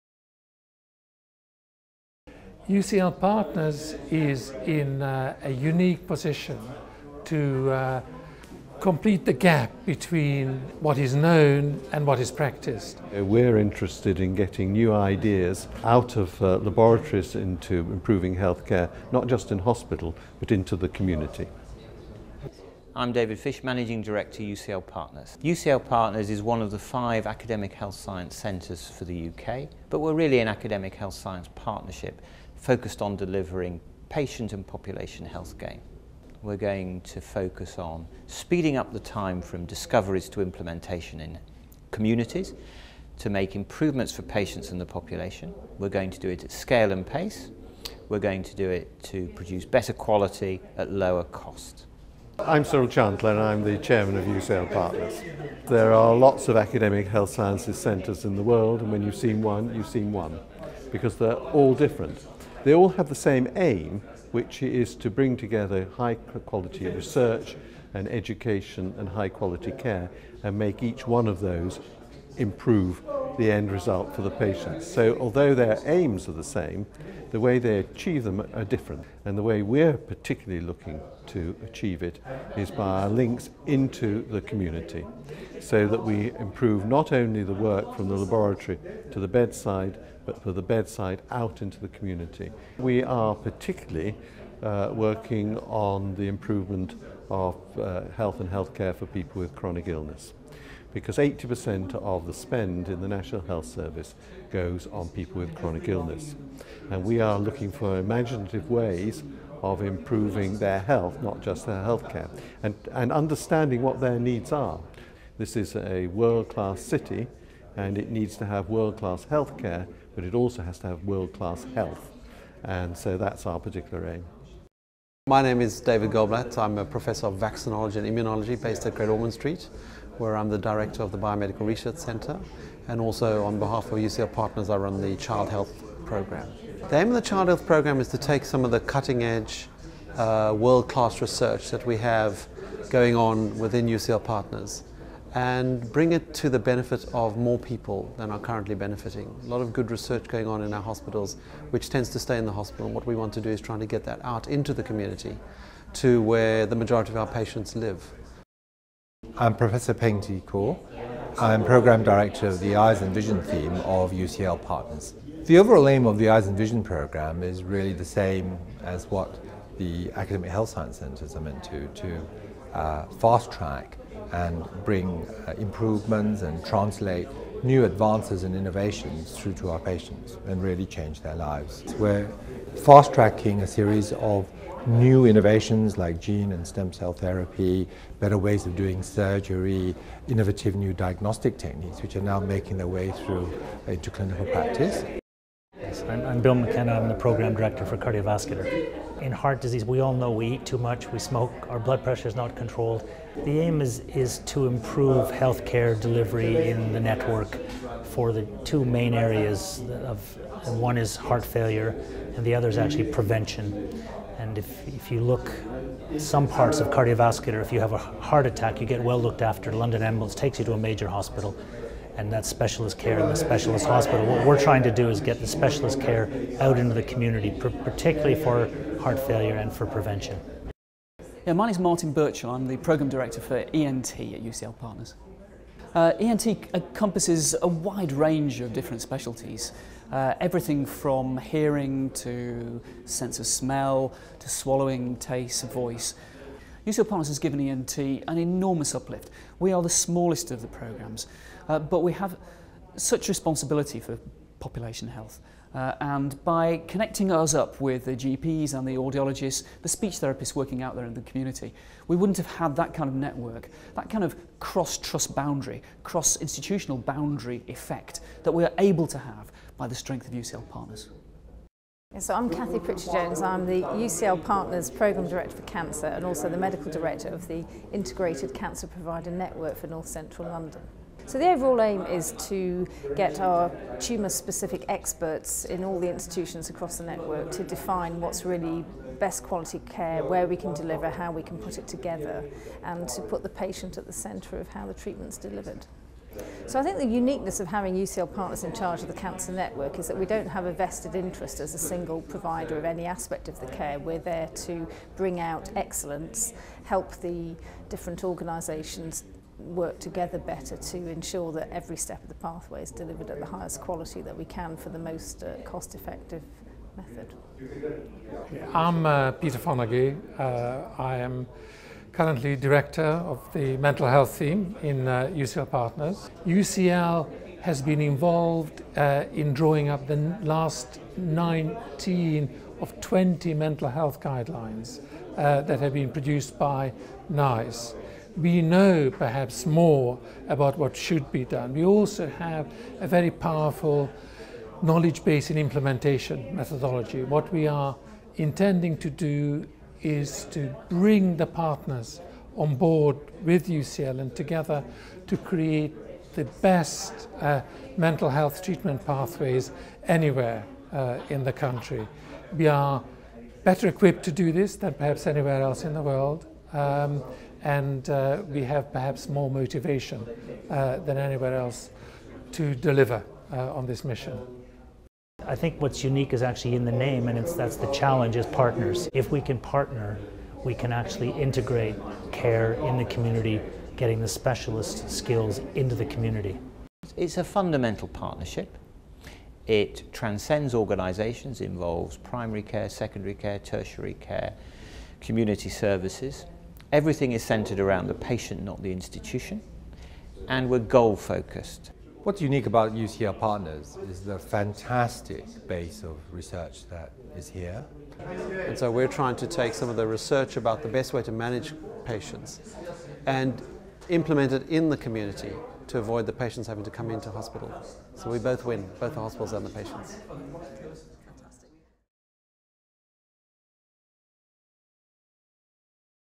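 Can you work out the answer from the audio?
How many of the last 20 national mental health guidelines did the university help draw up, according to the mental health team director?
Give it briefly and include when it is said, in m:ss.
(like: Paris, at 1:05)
19, at 5:31.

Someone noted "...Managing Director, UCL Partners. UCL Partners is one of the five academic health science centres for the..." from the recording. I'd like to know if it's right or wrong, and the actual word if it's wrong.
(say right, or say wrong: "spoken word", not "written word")
right.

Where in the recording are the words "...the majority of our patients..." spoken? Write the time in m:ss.
2:36.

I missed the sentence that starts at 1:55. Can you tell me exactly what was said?
This is a world-class city and it needs to have world-class healthcare but it also has to have world-class health.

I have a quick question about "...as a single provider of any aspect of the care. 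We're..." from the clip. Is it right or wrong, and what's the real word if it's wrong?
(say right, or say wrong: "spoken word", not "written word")
right.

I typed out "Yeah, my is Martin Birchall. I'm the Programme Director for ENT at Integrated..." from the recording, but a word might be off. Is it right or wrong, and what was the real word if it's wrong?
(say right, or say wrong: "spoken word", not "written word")
wrong: "UCL", not "Integrated".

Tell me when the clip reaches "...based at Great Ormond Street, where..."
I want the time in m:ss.
2:08.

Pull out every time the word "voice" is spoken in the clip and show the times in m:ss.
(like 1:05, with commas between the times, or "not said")
4:05.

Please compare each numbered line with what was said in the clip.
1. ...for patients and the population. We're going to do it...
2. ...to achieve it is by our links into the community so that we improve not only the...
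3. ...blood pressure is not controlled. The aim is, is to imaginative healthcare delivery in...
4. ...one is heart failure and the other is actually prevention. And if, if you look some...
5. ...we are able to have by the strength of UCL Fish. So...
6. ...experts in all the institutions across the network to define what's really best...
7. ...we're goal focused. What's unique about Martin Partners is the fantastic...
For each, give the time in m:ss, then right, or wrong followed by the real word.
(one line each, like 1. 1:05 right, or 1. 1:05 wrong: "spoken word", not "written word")
1. 0:44 right
2. 1:21 right
3. 3:21 wrong: "improve", not "imaginative"
4. 3:30 right
5. 4:28 wrong: "Partners", not "Fish"
6. 4:44 right
7. 6:40 wrong: "UCL", not "Martin".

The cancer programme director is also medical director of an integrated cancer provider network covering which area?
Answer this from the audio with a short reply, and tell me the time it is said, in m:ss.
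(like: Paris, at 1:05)
North Central London, at 4:39.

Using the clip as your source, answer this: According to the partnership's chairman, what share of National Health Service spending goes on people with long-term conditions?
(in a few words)
80%.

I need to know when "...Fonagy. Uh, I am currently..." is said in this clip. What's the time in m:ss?
5:19.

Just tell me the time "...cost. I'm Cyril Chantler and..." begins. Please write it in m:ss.
0:51.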